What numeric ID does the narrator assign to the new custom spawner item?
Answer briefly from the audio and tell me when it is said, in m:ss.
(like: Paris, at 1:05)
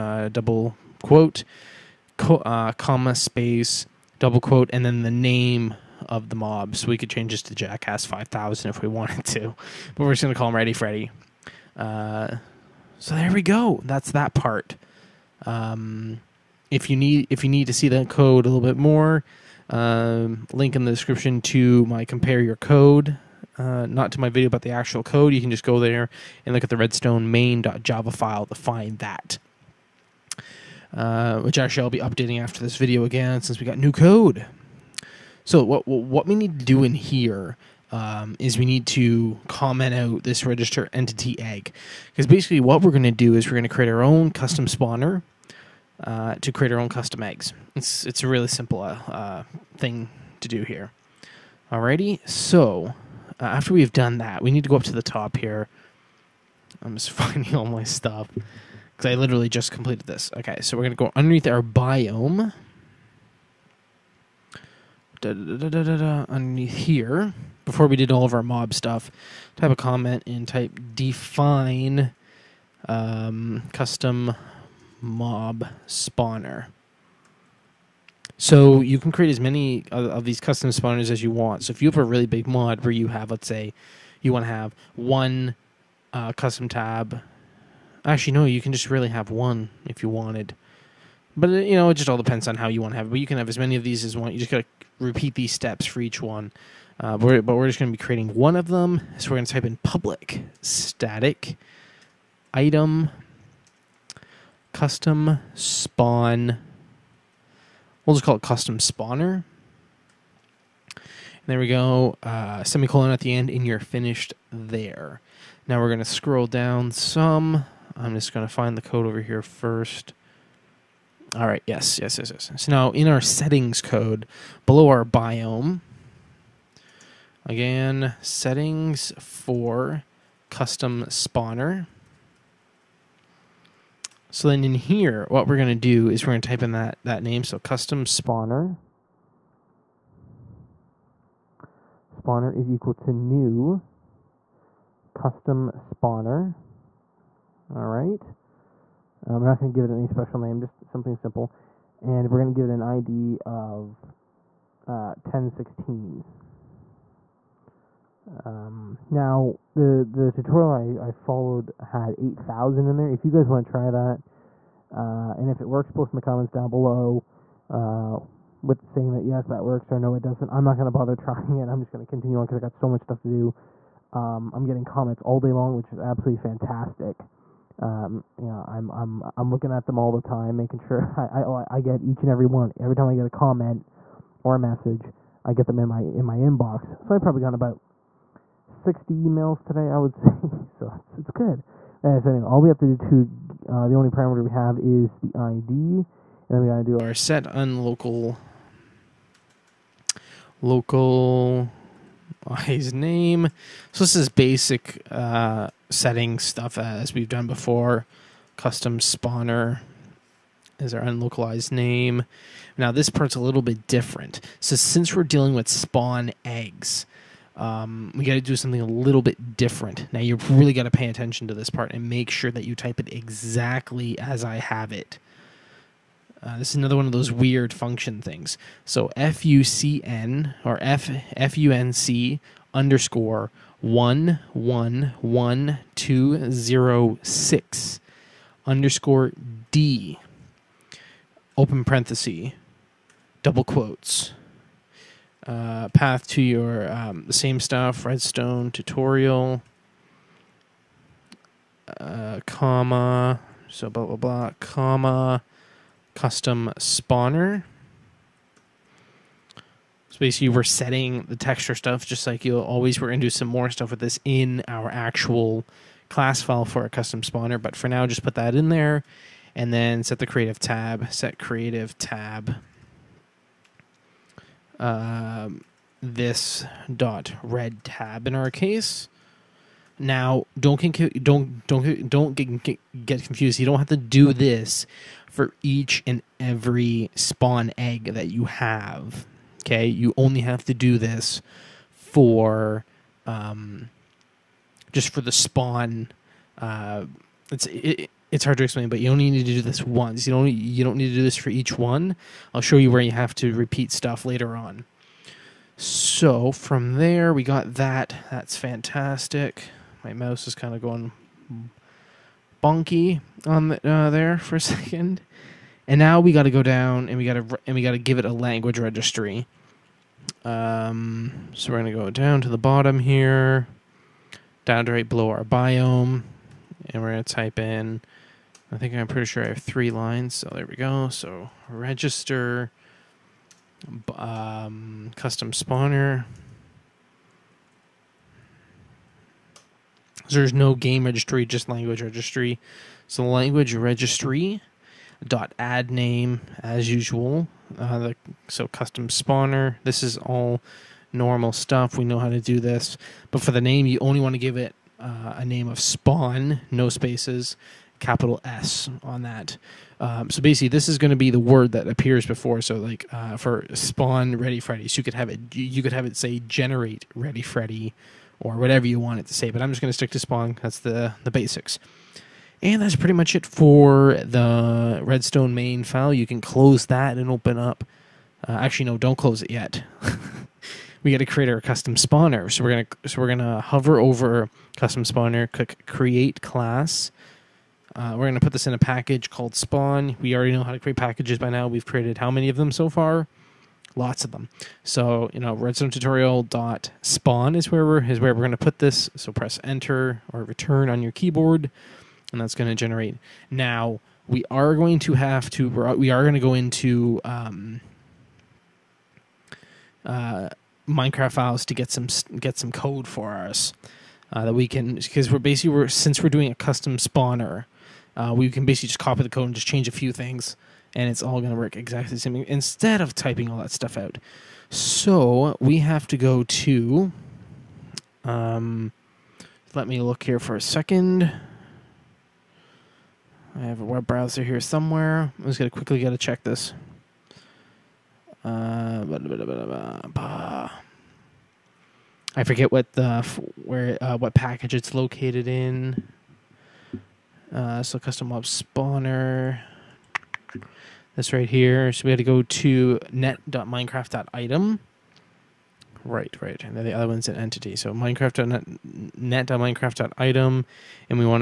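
1016, at 2:35.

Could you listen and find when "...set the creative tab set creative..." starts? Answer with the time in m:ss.
4:30.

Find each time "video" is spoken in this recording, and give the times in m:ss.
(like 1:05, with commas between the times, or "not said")
0:24, 0:32.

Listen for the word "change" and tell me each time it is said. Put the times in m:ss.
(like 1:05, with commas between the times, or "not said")
0:07, 6:59.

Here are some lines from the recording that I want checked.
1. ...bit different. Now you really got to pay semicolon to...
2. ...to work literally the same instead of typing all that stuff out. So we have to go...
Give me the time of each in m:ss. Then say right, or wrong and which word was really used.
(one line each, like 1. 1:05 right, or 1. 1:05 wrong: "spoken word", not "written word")
1. 3:39 wrong: "attention", not "semicolon"
2. 7:01 wrong: "exactly", not "literally".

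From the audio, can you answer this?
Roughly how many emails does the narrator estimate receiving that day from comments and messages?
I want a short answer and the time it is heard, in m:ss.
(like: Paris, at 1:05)
60, at 3:08.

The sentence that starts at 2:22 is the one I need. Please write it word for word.
Spawner is equal to new custom spawner.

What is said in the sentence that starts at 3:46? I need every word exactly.
Uh, this is another one of those weird function things.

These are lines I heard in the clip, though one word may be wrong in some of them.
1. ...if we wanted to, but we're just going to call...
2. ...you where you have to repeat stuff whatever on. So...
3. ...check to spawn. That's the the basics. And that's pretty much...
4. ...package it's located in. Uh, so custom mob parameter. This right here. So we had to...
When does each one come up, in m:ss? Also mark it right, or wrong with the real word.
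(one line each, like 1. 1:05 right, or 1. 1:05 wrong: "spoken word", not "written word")
1. 0:08 right
2. 5:02 wrong: "later", not "whatever"
3. 6:09 wrong: "stick", not "check"
4. 7:24 wrong: "spawner", not "parameter".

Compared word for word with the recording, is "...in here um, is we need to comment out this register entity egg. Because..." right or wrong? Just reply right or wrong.
right.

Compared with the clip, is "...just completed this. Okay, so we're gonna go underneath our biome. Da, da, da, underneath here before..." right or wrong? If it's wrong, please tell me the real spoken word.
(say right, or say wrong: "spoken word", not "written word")
right.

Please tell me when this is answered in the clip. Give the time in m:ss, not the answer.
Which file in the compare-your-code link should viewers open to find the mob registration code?
0:26.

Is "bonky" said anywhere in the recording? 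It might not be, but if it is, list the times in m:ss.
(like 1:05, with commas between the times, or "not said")
5:12.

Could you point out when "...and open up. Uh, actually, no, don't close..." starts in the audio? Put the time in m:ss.
6:17.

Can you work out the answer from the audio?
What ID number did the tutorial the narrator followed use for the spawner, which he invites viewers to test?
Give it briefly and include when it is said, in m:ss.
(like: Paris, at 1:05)
8000, at 2:42.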